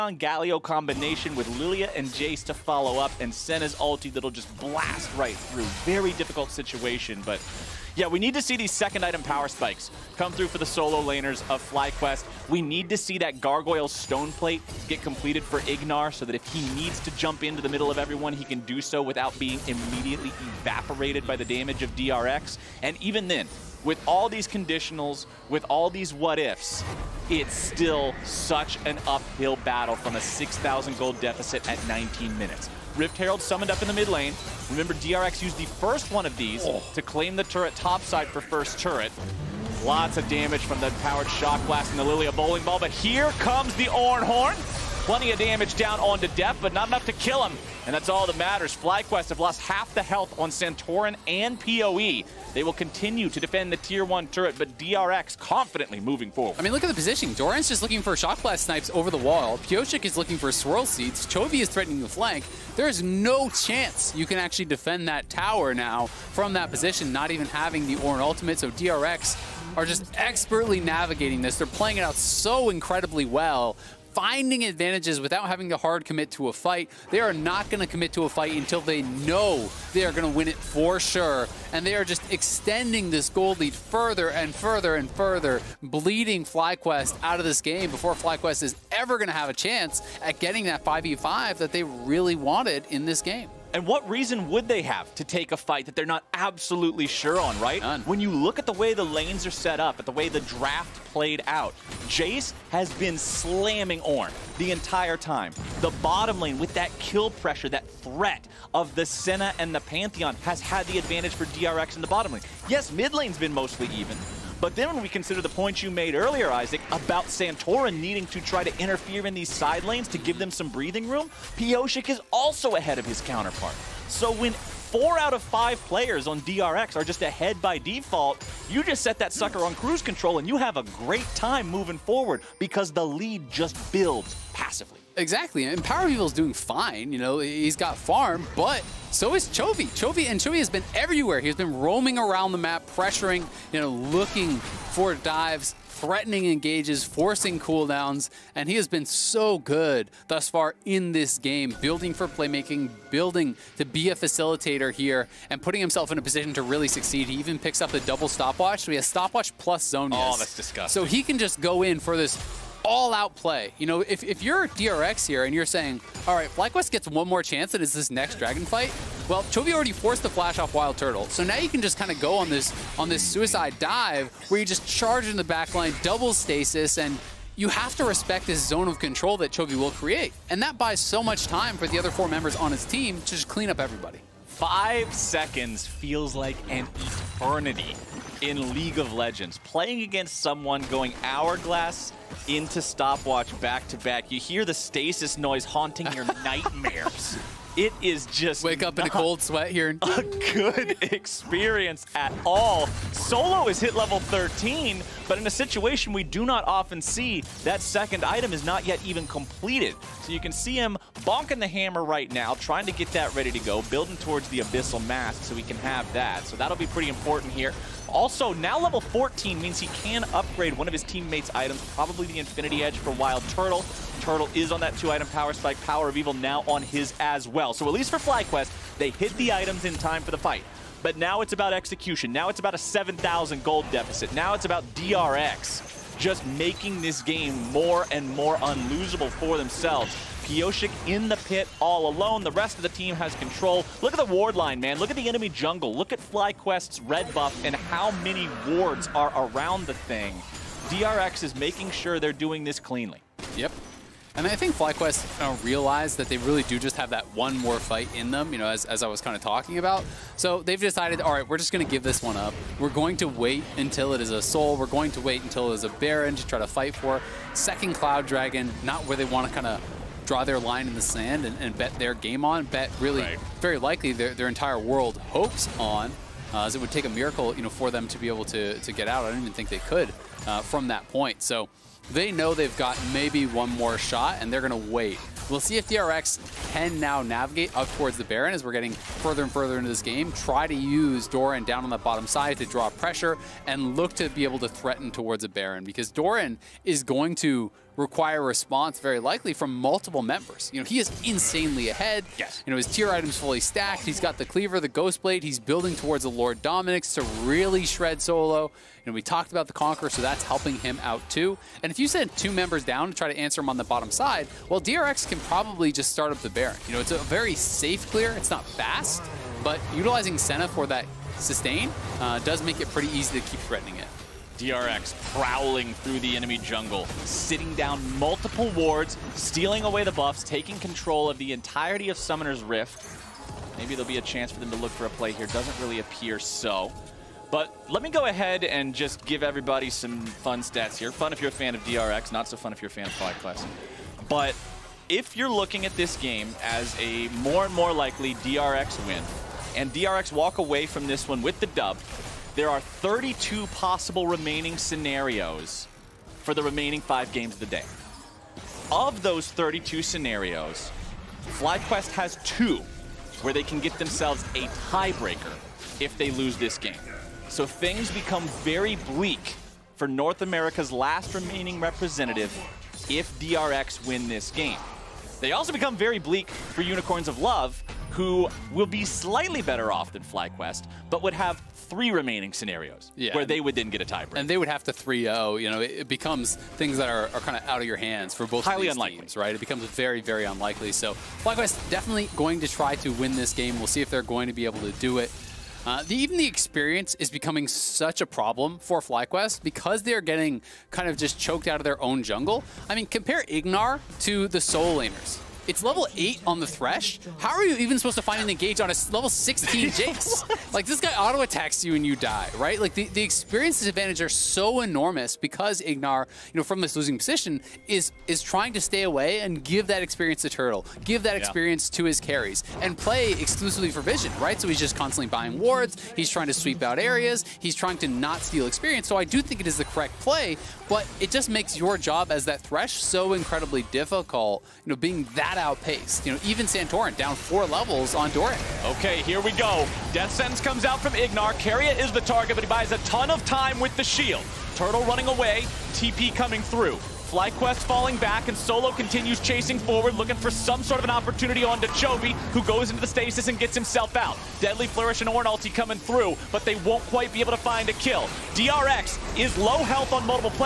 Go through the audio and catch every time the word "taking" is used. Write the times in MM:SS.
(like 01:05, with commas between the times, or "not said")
05:30.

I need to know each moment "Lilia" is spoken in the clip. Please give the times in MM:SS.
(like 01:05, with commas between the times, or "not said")
00:01, 00:42.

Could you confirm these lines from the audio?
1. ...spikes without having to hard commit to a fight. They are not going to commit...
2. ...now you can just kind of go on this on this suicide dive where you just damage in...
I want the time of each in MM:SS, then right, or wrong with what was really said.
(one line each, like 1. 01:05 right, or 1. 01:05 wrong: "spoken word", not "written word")
1. 01:14 wrong: "advantages", not "spikes"
2. 02:51 wrong: "charge", not "damage".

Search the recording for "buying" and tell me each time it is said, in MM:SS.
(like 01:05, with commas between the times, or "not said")
07:05.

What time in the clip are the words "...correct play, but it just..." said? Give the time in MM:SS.
07:09.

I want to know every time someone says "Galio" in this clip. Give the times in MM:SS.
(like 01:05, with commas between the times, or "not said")
00:00.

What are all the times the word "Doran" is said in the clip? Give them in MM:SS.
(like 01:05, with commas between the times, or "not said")
00:57, 04:51, 04:56.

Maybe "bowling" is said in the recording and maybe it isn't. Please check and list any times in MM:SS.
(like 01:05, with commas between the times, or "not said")
00:42.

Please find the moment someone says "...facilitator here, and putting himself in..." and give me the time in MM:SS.
02:34.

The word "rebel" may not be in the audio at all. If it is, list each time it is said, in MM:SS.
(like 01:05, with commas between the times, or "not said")
not said.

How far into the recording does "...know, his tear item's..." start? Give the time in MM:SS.
05:02.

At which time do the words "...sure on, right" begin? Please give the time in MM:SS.
01:37.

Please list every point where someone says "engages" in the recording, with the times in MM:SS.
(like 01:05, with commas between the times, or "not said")
02:26, 06:48.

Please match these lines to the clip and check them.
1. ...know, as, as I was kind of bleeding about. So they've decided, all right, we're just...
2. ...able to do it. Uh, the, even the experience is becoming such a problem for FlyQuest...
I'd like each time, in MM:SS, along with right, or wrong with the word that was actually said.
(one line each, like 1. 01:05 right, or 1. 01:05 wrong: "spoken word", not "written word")
1. 04:18 wrong: "talking", not "bleeding"
2. 06:34 right.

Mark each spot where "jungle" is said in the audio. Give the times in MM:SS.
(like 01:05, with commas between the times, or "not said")
04:05, 05:26, 06:42.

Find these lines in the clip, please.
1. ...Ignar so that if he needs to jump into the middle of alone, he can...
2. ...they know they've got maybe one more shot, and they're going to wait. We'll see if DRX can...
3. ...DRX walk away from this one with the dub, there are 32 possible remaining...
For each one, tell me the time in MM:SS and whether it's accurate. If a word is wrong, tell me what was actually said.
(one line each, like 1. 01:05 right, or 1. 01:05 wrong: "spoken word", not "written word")
1. 00:15 wrong: "everyone", not "alone"
2. 04:42 right
3. 05:49 right.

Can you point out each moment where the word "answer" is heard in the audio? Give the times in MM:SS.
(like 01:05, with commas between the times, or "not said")
05:13.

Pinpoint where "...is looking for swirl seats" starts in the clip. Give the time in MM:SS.
01:00.